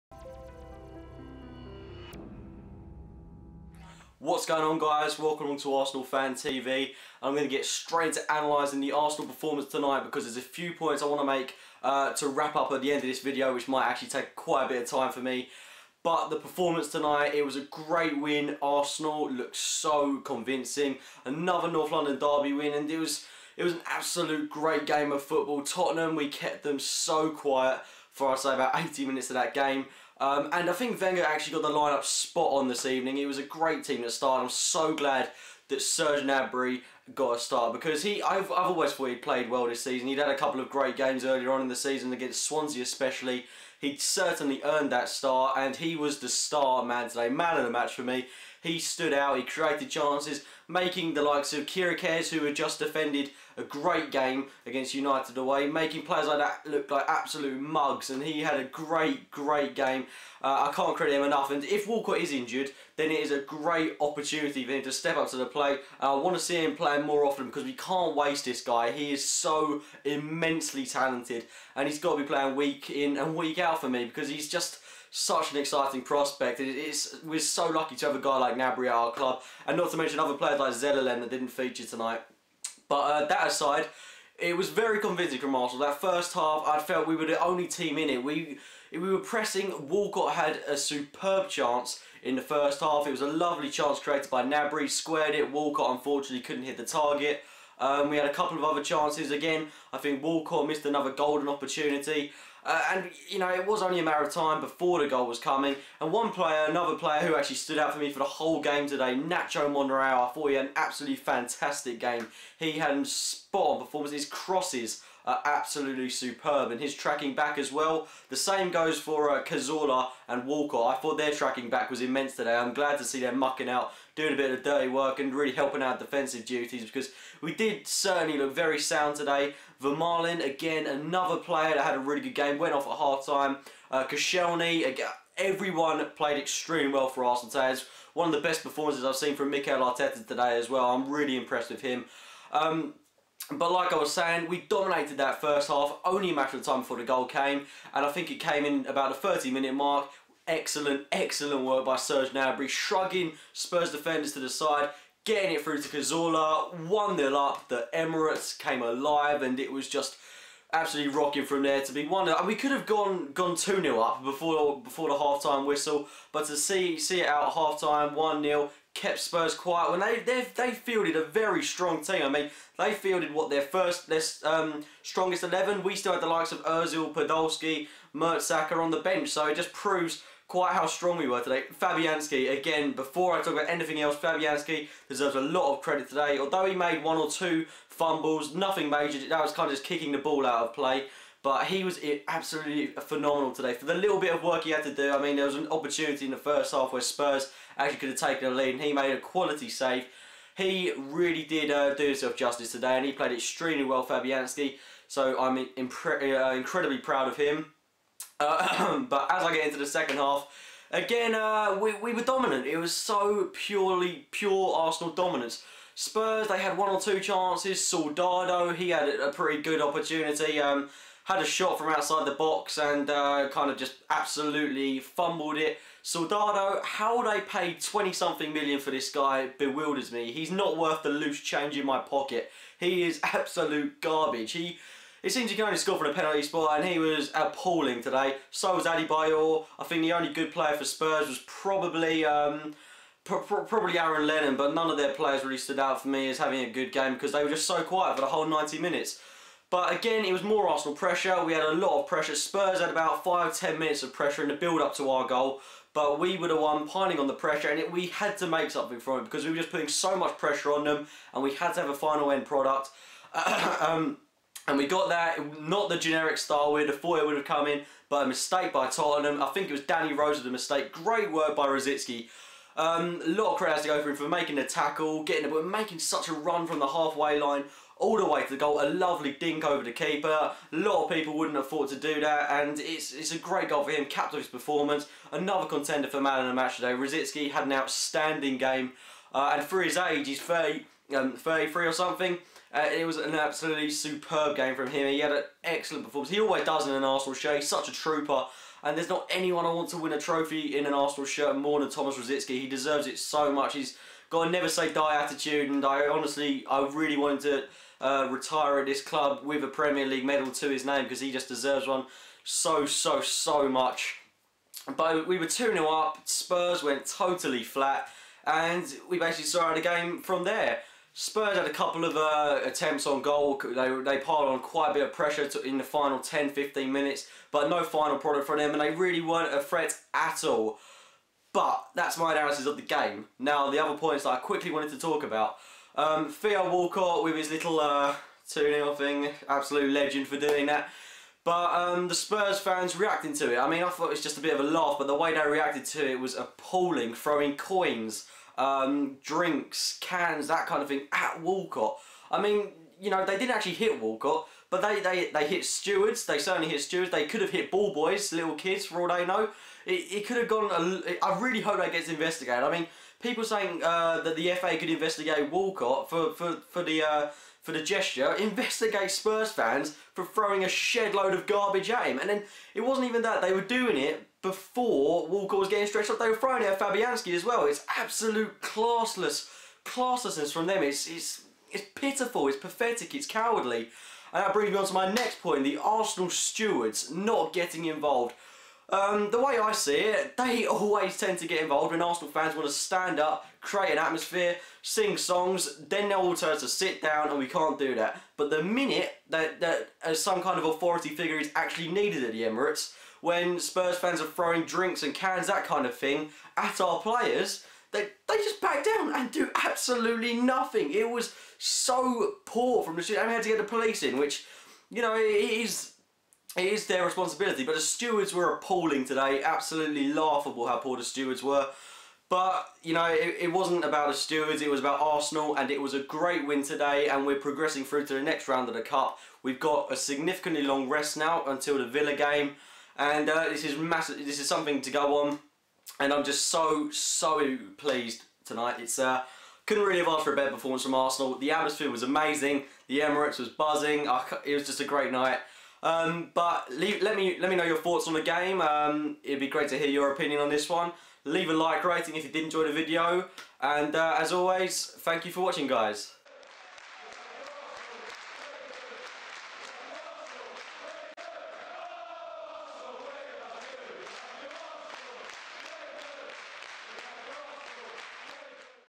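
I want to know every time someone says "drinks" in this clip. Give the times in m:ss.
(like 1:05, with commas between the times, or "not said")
5:49, 6:44.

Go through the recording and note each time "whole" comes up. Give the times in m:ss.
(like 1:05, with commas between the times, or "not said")
1:48, 4:08.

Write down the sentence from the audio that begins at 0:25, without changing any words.
Tottenham, we kept them so quiet for, I'd say, about 80 minutes of that game.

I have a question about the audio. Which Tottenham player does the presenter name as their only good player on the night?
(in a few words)
Aaron Lennon.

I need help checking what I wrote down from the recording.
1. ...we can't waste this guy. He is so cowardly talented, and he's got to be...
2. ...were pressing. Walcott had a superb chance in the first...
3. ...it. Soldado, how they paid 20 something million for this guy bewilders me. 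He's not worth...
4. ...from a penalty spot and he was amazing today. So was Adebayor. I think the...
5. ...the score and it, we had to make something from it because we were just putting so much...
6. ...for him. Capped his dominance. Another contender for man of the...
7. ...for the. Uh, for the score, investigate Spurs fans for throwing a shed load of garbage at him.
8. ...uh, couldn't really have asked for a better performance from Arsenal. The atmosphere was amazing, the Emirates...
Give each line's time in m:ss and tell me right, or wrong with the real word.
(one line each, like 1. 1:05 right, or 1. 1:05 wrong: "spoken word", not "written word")
1. 1:07 wrong: "immensely", not "cowardly"
2. 1:28 right
3. 3:45 right
4. 3:55 wrong: "appalling", not "amazing"
5. 4:17 wrong: "pressure", not "score"
6. 4:43 wrong: "performance", not "dominance"
7. 6:06 wrong: "gesture", not "score"
8. 7:18 right.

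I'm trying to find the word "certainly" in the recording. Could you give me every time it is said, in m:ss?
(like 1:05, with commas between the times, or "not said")
0:43, 2:07, 5:56.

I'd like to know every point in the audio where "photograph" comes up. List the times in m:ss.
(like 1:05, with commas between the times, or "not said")
not said.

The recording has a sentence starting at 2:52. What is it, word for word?
I mean, they fielded what their first their um, strongest eleven.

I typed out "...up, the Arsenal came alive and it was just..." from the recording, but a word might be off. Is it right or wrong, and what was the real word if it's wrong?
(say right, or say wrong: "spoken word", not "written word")
wrong: "Emirates", not "Arsenal".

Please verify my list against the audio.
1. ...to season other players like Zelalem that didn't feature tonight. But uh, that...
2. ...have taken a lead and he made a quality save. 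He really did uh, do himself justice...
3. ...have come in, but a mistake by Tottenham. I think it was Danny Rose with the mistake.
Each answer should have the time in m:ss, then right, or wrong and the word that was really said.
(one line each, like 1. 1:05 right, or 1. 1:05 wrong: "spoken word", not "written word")
1. 1:19 wrong: "mention", not "season"
2. 3:18 right
3. 4:27 right.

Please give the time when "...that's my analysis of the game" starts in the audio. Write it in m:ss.
5:31.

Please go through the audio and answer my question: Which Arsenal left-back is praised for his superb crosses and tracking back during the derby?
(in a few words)
Nacho Monreal.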